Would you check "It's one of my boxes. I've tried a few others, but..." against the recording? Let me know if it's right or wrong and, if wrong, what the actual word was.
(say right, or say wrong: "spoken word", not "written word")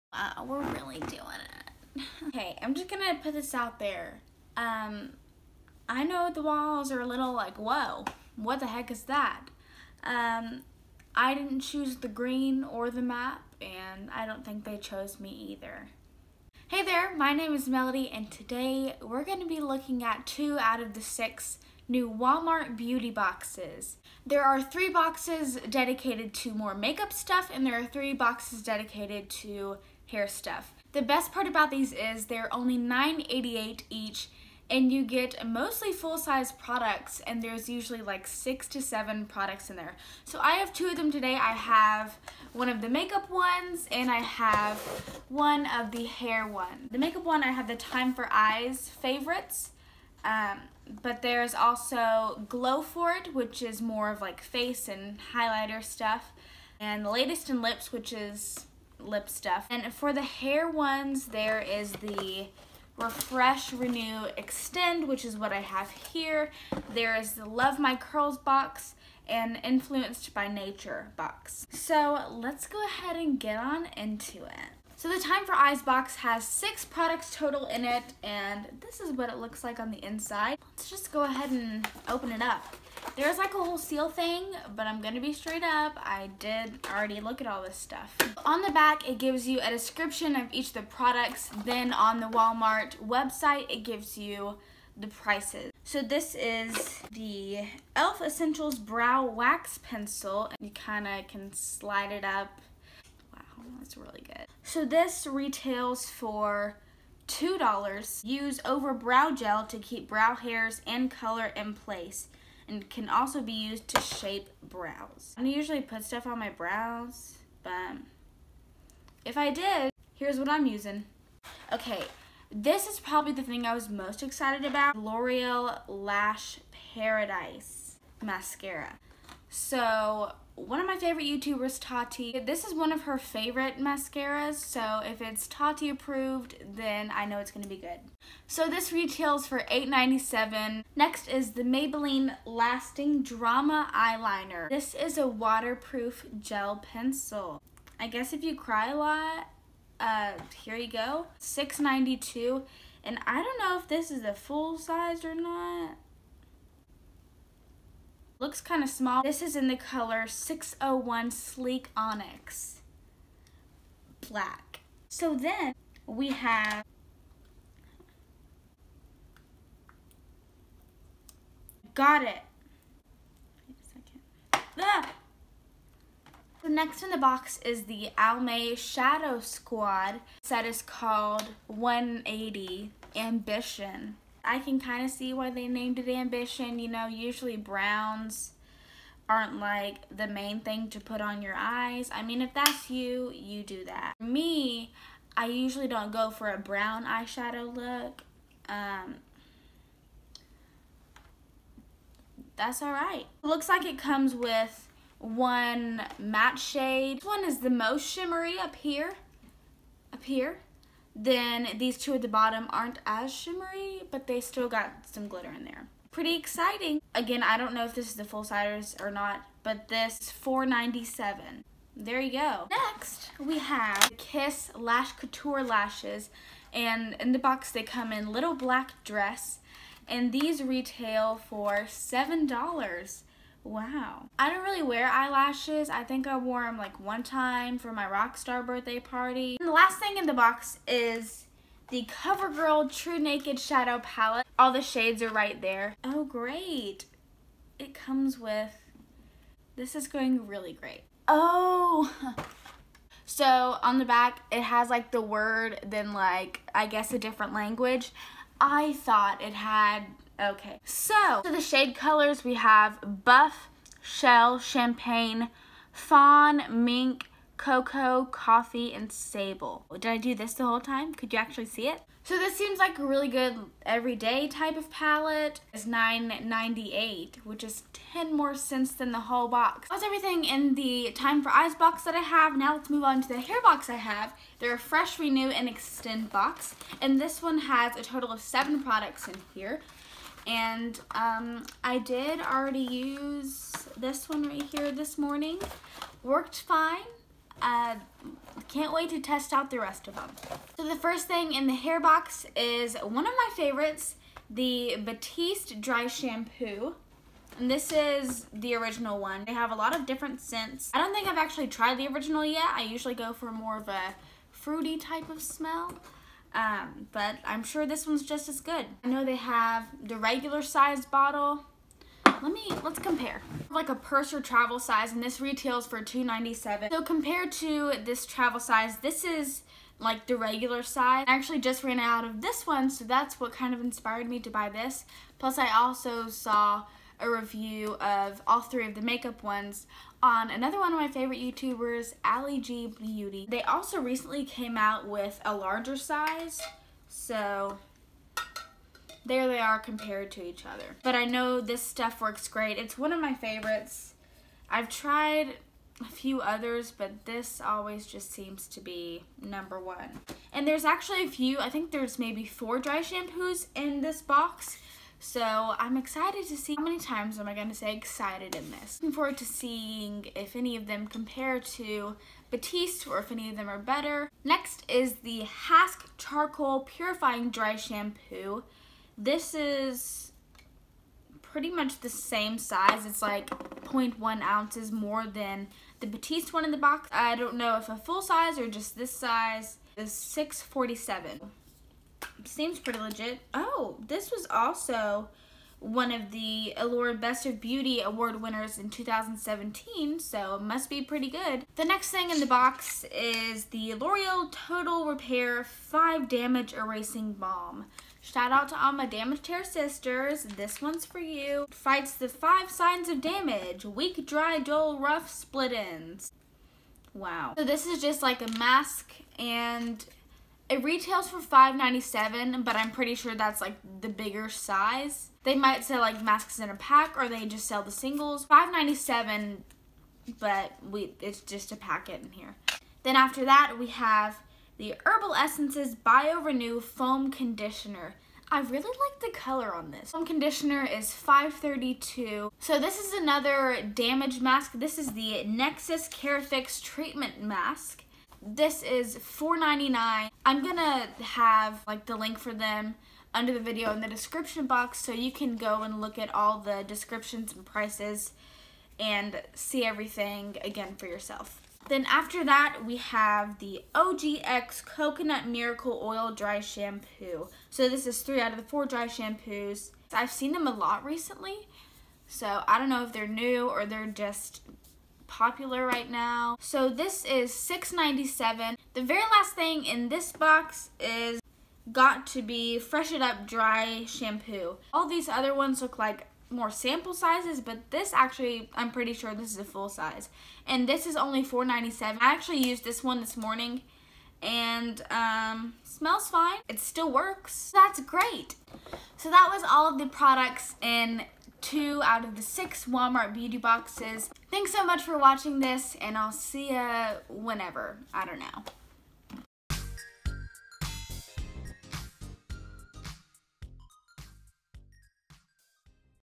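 wrong: "favorites", not "boxes".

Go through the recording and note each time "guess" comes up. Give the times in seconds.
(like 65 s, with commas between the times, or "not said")
148 s, 256 s.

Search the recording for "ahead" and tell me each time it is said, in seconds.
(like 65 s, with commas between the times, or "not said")
72 s, 81 s.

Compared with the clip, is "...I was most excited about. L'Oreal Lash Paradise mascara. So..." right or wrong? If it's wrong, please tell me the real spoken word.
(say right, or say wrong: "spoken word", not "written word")
right.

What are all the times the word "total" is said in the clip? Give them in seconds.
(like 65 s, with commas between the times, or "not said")
77 s, 288 s, 404 s.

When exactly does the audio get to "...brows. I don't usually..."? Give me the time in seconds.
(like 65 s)
114 s.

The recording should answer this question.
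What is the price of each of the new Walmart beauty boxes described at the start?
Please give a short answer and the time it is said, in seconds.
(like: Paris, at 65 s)
$9.88, at 32 s.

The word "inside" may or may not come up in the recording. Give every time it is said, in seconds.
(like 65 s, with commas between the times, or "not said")
80 s.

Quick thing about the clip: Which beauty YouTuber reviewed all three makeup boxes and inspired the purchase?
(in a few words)
Allie G Beauty.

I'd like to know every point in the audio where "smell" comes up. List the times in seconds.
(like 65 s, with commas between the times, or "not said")
315 s, 495 s.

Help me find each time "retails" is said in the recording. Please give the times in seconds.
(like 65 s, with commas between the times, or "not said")
105 s, 138 s, 230 s, 325 s, 420 s.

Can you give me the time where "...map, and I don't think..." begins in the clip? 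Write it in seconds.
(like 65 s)
13 s.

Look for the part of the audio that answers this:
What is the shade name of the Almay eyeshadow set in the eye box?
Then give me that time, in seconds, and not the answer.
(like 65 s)
181 s.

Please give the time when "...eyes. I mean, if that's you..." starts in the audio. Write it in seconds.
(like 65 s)
191 s.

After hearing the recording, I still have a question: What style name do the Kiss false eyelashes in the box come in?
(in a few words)
Little Black Dress.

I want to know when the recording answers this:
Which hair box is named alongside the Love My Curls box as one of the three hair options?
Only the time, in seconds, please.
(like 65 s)
69 s.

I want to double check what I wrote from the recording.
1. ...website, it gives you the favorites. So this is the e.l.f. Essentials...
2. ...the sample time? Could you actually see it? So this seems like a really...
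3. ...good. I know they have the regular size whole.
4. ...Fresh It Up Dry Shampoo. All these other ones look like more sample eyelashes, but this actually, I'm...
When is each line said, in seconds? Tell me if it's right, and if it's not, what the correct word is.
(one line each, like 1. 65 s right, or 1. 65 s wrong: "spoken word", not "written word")
1. 93 s wrong: "prices", not "favorites"
2. 270 s wrong: "whole", not "sample"
3. 318 s wrong: "bottle", not "whole"
4. 482 s wrong: "sizes", not "eyelashes".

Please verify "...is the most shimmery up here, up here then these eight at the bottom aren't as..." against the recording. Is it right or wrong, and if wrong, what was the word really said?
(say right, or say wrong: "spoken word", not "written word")
wrong: "two", not "eight".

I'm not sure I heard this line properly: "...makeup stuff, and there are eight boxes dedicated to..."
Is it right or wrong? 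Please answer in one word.
wrong.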